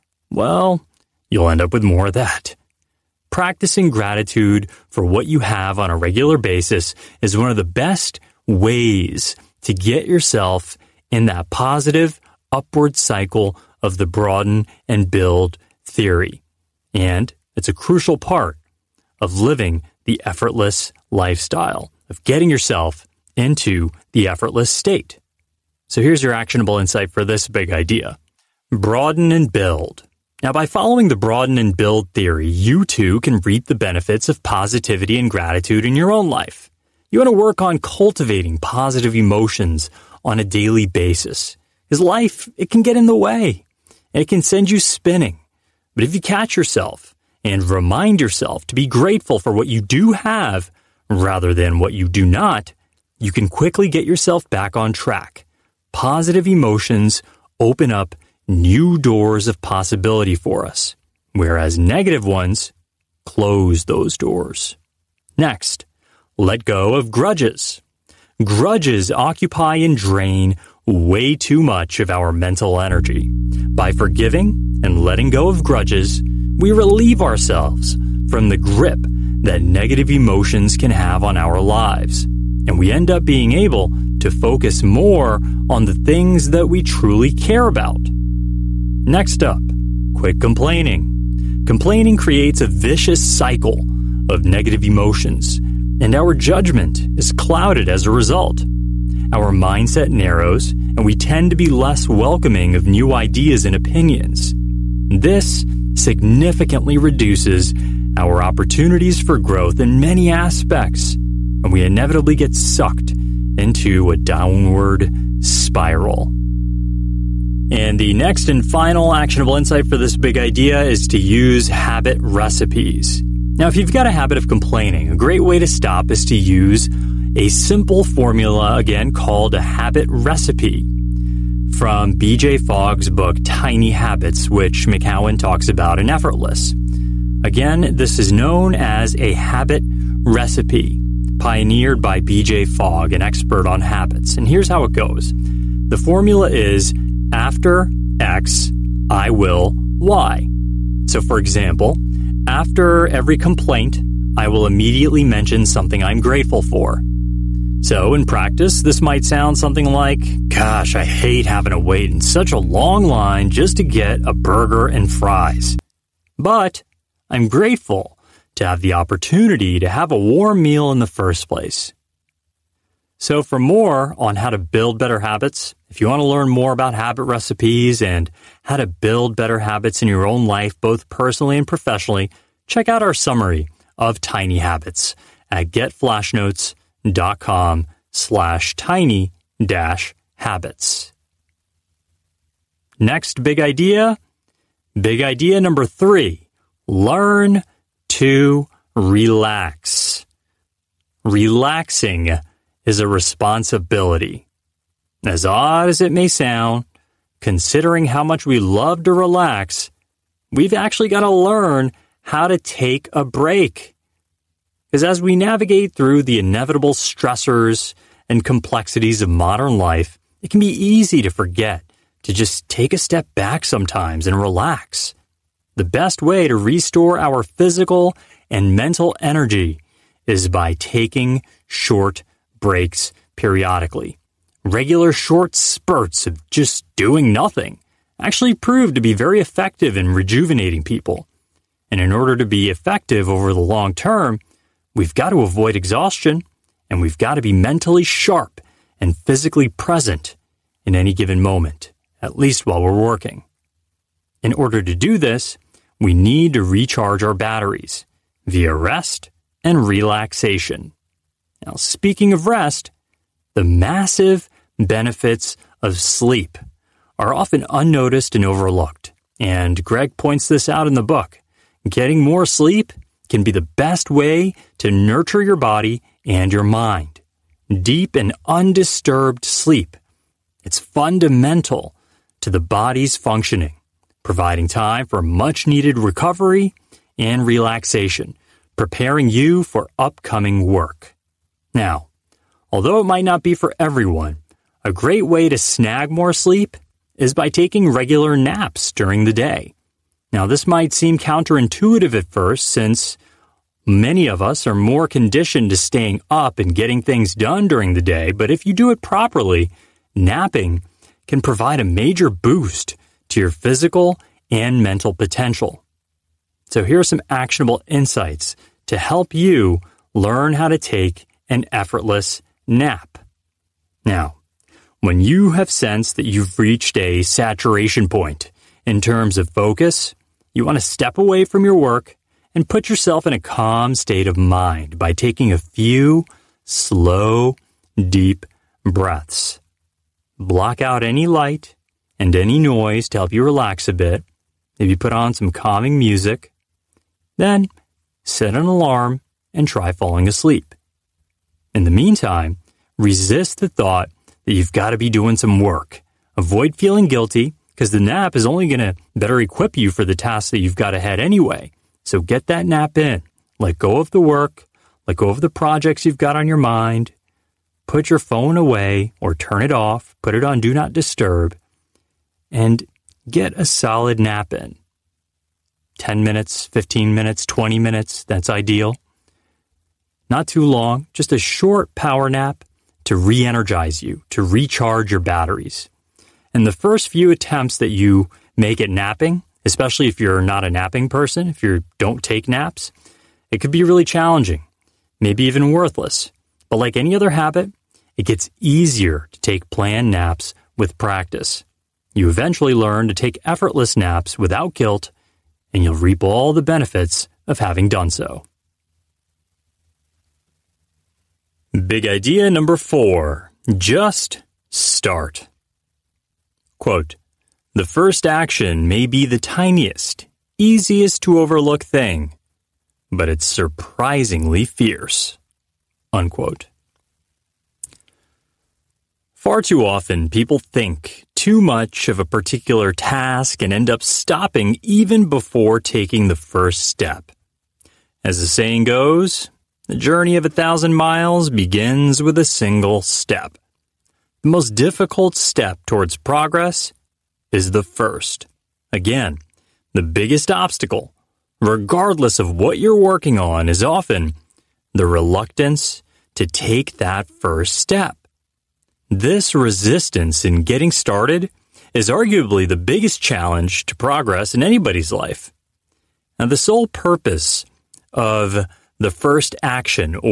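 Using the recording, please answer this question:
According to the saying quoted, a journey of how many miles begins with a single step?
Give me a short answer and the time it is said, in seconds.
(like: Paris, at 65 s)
1000, at 440 s.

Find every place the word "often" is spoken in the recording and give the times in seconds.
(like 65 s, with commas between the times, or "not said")
267 s, 429 s, 453 s.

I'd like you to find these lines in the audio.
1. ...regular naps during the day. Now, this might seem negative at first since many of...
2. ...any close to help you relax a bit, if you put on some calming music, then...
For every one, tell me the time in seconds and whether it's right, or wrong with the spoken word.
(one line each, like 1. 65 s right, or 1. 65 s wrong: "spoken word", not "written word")
1. 297 s wrong: "counterintuitive", not "negative"
2. 342 s wrong: "noise", not "close".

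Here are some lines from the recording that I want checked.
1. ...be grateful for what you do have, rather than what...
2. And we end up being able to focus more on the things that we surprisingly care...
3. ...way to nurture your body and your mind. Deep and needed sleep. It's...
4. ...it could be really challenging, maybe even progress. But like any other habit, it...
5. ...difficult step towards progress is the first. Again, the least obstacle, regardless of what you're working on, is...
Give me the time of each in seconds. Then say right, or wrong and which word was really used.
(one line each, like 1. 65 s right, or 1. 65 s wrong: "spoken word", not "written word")
1. 48 s right
2. 82 s wrong: "truly", not "surprisingly"
3. 274 s wrong: "undisturbed", not "needed"
4. 393 s wrong: "worthless", not "progress"
5. 444 s wrong: "biggest", not "least".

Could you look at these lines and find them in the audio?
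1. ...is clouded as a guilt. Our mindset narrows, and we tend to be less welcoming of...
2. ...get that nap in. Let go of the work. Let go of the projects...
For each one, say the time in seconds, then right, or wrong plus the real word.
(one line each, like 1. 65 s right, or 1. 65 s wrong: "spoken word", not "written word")
1. 97 s wrong: "result", not "guilt"
2. 362 s right.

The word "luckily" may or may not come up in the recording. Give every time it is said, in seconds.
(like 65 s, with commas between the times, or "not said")
not said.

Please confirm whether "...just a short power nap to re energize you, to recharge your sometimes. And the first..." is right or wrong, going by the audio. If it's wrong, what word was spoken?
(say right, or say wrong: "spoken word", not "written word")
wrong: "batteries", not "sometimes".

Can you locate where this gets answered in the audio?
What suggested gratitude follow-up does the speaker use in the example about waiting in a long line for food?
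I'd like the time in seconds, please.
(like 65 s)
170 s.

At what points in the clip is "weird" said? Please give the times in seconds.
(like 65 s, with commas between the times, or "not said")
not said.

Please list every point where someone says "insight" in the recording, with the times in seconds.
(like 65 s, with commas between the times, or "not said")
26 s, 119 s, 317 s.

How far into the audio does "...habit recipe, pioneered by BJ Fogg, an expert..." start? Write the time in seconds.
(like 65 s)
139 s.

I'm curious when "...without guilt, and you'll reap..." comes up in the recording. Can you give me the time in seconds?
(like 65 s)
404 s.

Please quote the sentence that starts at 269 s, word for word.
And Greg points this out in the book.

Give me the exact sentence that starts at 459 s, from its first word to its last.
This resistance in getting started is arguably the biggest challenge to progress in anybody's life.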